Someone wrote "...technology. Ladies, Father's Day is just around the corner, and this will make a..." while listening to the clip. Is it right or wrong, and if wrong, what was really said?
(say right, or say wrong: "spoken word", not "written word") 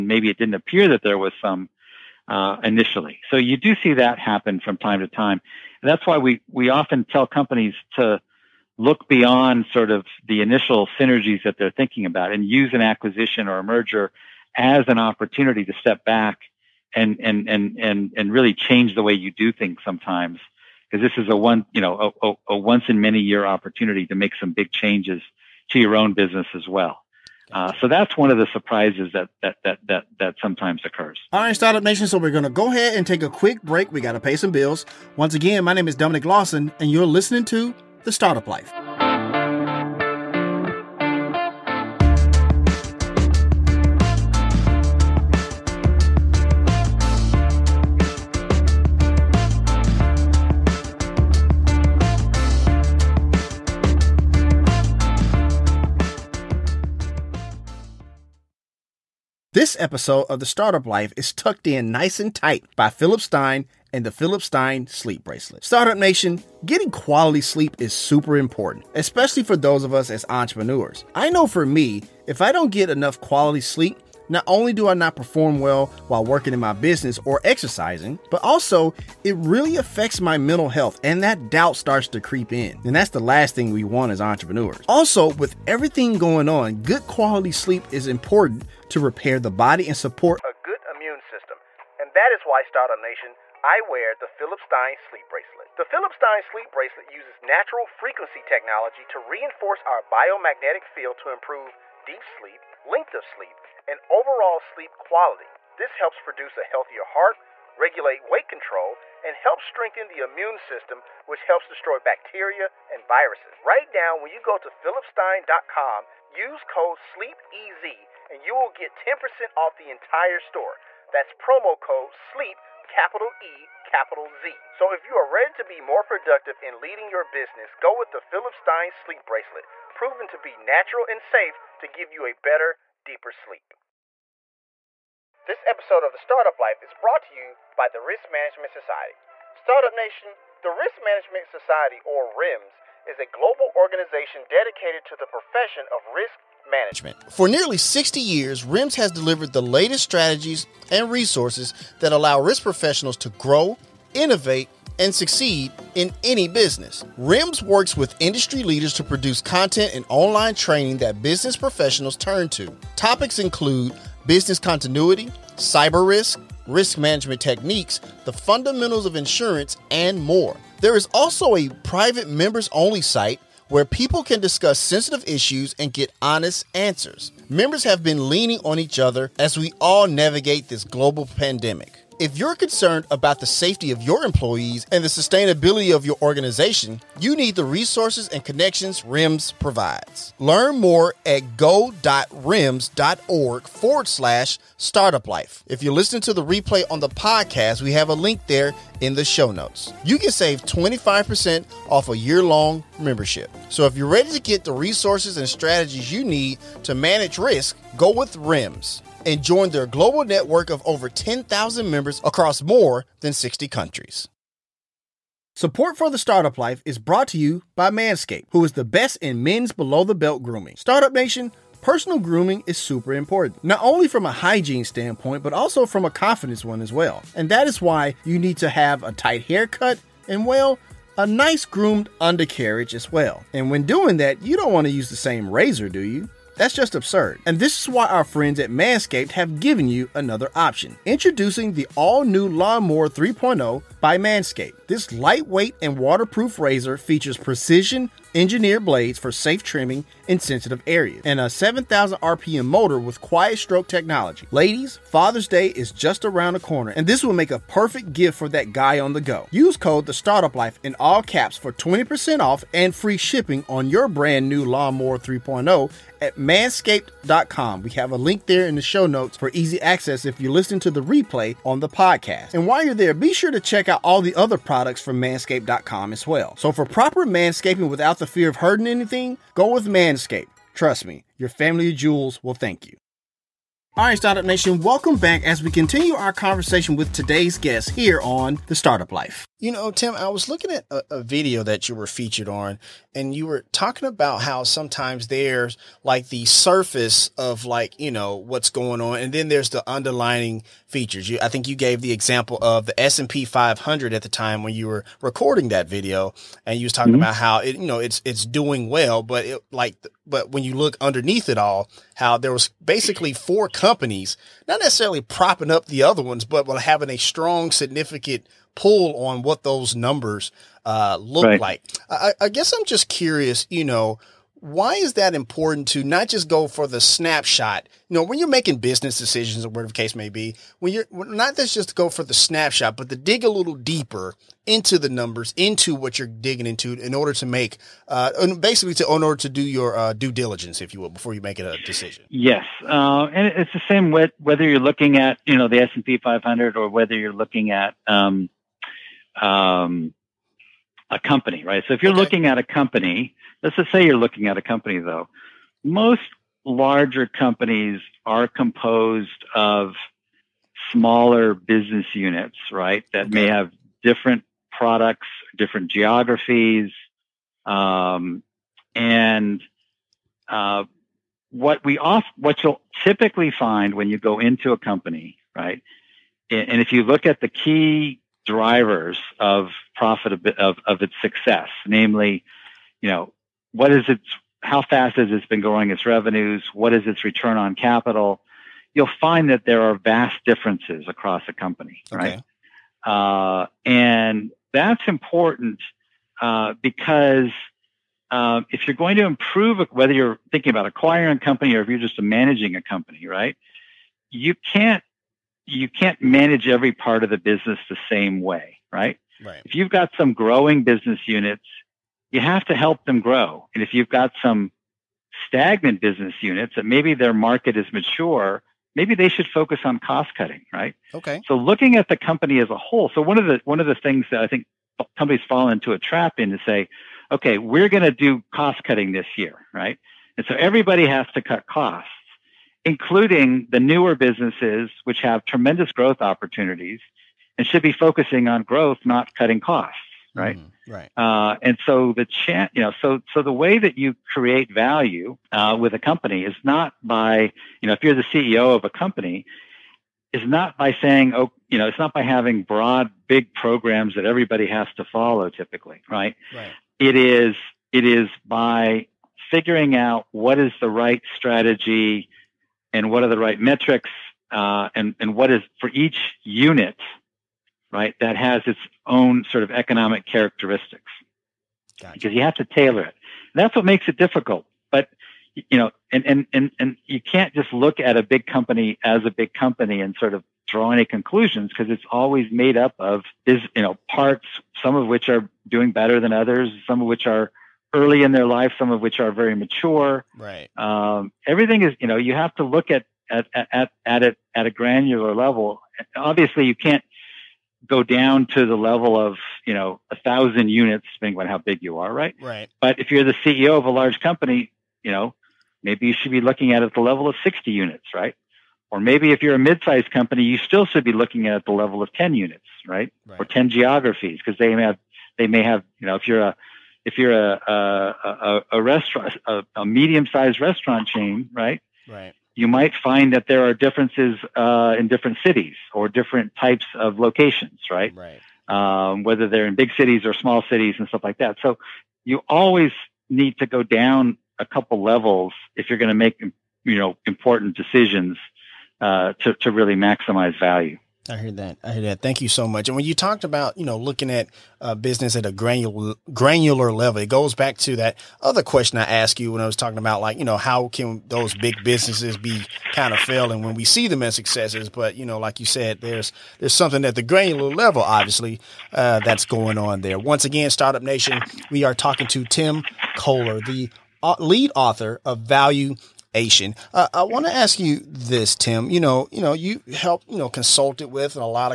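right.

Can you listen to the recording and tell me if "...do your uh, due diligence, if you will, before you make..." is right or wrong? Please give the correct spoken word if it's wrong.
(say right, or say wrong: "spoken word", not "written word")
right.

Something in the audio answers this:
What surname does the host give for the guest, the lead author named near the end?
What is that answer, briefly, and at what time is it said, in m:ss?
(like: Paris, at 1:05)
Koller, at 9:23.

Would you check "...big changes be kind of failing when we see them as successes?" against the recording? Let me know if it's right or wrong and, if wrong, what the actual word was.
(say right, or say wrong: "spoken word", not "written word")
wrong: "businesses", not "changes".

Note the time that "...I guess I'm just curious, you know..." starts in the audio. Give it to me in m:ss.
5:22.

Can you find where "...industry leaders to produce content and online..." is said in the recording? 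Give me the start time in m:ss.
2:38.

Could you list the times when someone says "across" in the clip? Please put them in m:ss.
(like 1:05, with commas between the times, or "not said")
3:32, 6:31.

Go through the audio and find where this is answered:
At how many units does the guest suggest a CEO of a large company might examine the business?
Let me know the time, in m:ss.
8:27.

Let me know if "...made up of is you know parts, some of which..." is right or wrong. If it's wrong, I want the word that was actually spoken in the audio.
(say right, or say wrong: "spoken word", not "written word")
right.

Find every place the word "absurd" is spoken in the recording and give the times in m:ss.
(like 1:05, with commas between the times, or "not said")
3:56.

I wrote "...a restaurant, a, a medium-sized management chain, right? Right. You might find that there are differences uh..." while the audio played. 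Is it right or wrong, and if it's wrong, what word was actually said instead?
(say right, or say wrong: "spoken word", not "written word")
wrong: "restaurant", not "management".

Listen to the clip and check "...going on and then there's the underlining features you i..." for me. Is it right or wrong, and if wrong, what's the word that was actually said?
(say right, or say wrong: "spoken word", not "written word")
right.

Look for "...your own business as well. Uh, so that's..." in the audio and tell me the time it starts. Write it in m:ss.
0:25.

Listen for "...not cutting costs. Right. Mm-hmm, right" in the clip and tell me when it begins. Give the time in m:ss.
7:19.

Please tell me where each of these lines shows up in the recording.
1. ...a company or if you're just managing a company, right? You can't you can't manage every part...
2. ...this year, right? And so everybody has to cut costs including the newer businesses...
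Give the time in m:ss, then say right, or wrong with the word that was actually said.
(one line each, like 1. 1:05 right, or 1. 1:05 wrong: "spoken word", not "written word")
1. 6:41 right
2. 7:09 right.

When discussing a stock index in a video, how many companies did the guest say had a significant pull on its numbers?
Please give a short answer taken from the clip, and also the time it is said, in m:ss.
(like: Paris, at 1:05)
4, at 5:13.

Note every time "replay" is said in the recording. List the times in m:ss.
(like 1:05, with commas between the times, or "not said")
3:16, 4:31.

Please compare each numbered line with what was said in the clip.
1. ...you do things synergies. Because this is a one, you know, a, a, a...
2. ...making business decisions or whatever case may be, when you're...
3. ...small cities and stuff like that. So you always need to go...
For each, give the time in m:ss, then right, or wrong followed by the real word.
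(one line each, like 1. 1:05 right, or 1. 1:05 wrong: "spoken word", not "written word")
1. 0:19 wrong: "sometimes", not "synergies"
2. 5:28 right
3. 8:50 right.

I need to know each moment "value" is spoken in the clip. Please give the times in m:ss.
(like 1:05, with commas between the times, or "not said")
7:24, 9:00, 9:25.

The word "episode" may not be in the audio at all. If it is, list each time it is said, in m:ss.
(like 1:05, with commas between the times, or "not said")
0:59, 2:15.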